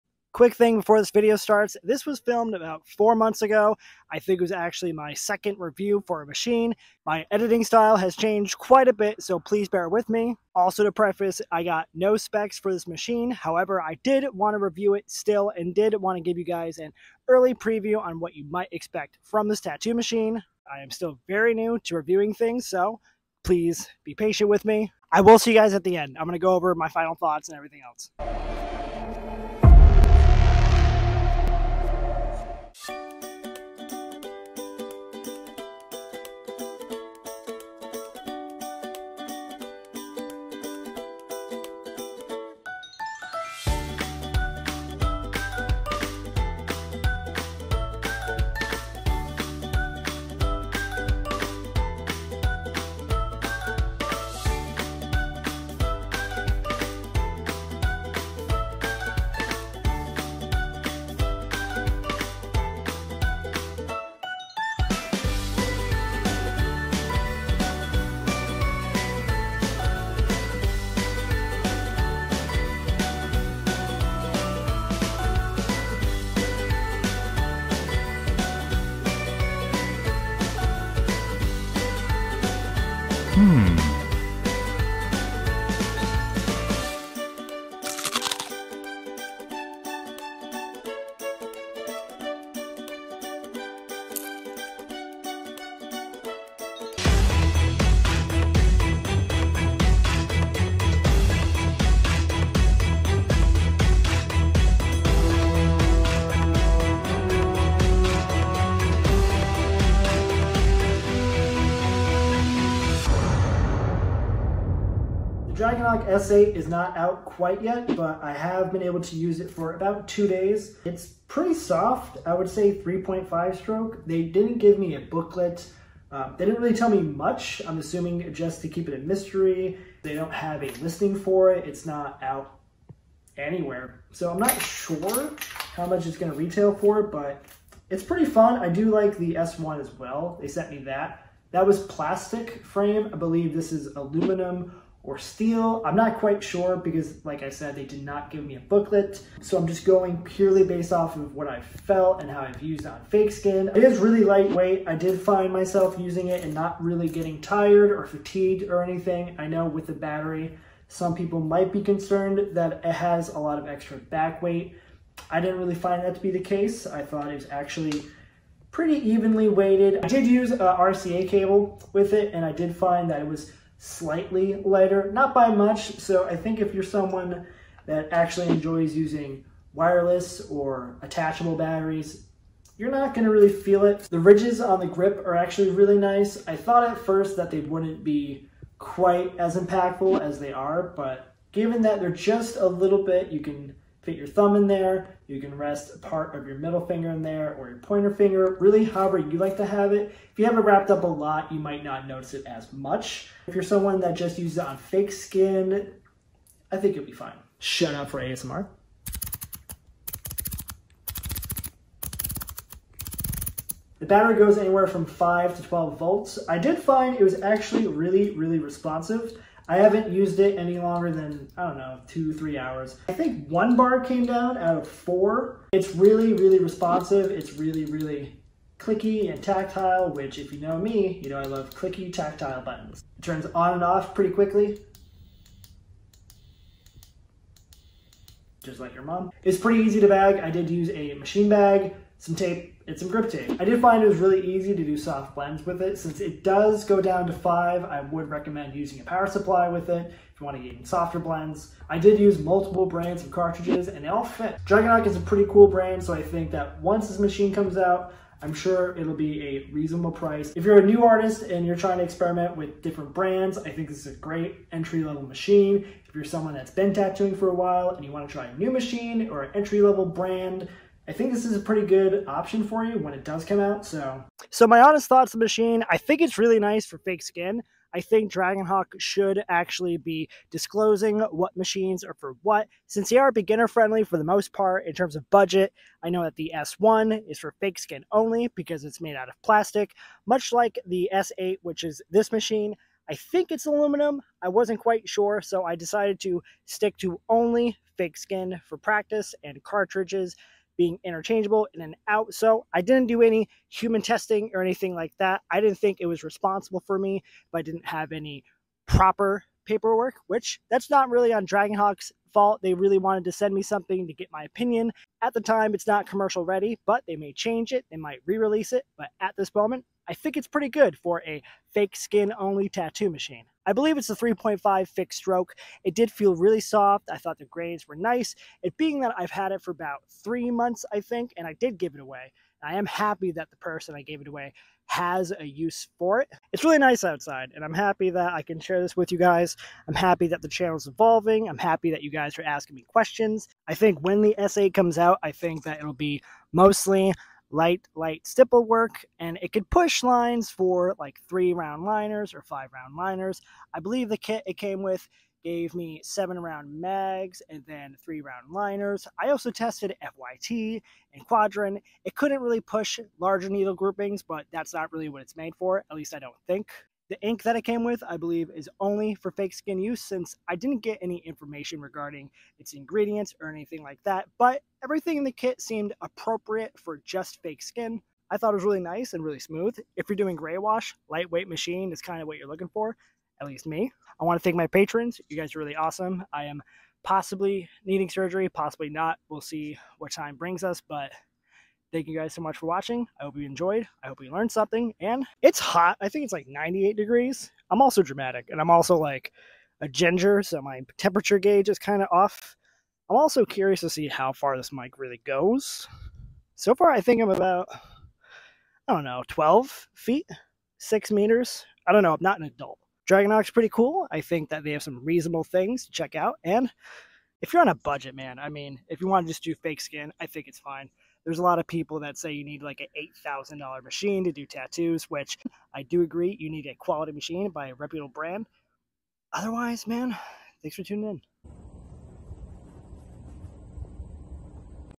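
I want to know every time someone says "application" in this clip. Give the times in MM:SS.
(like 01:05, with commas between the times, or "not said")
not said.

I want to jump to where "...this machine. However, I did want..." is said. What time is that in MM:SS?
00:12.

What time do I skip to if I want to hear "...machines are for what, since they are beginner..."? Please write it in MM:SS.
04:41.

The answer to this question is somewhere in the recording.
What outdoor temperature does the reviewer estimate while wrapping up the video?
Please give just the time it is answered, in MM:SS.
06:36.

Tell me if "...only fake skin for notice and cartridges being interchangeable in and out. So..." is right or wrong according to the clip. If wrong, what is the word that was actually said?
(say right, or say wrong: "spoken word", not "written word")
wrong: "practice", not "notice".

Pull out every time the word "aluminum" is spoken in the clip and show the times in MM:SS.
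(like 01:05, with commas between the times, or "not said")
02:23, 04:53.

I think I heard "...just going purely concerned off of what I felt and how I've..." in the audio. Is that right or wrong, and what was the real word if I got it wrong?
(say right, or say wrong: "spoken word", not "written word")
wrong: "based", not "concerned".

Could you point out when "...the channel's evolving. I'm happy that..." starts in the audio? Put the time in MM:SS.
05:40.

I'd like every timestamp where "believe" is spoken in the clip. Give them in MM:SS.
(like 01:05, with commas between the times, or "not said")
02:23, 05:23, 05:53, 06:08.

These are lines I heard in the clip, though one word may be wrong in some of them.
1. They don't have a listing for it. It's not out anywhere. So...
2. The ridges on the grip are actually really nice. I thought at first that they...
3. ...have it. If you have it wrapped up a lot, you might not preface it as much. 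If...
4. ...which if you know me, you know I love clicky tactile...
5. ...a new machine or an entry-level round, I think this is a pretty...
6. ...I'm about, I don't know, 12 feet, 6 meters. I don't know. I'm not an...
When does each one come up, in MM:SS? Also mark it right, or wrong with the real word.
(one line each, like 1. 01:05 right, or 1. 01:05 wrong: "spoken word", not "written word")
1. 02:10 right
2. 03:04 right
3. 03:19 wrong: "notice", not "preface"
4. 03:50 right
5. 04:28 wrong: "brand", not "round"
6. 06:47 right.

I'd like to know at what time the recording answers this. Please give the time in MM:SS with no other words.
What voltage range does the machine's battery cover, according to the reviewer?
03:35.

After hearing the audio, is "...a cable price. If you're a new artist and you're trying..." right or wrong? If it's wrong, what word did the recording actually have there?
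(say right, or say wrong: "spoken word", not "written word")
wrong: "reasonable", not "cable".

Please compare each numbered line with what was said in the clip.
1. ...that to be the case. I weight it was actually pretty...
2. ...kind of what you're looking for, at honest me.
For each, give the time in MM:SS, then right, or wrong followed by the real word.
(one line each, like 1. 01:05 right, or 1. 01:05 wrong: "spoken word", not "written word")
1. 02:46 wrong: "thought", not "weight"
2. 06:22 wrong: "least", not "honest".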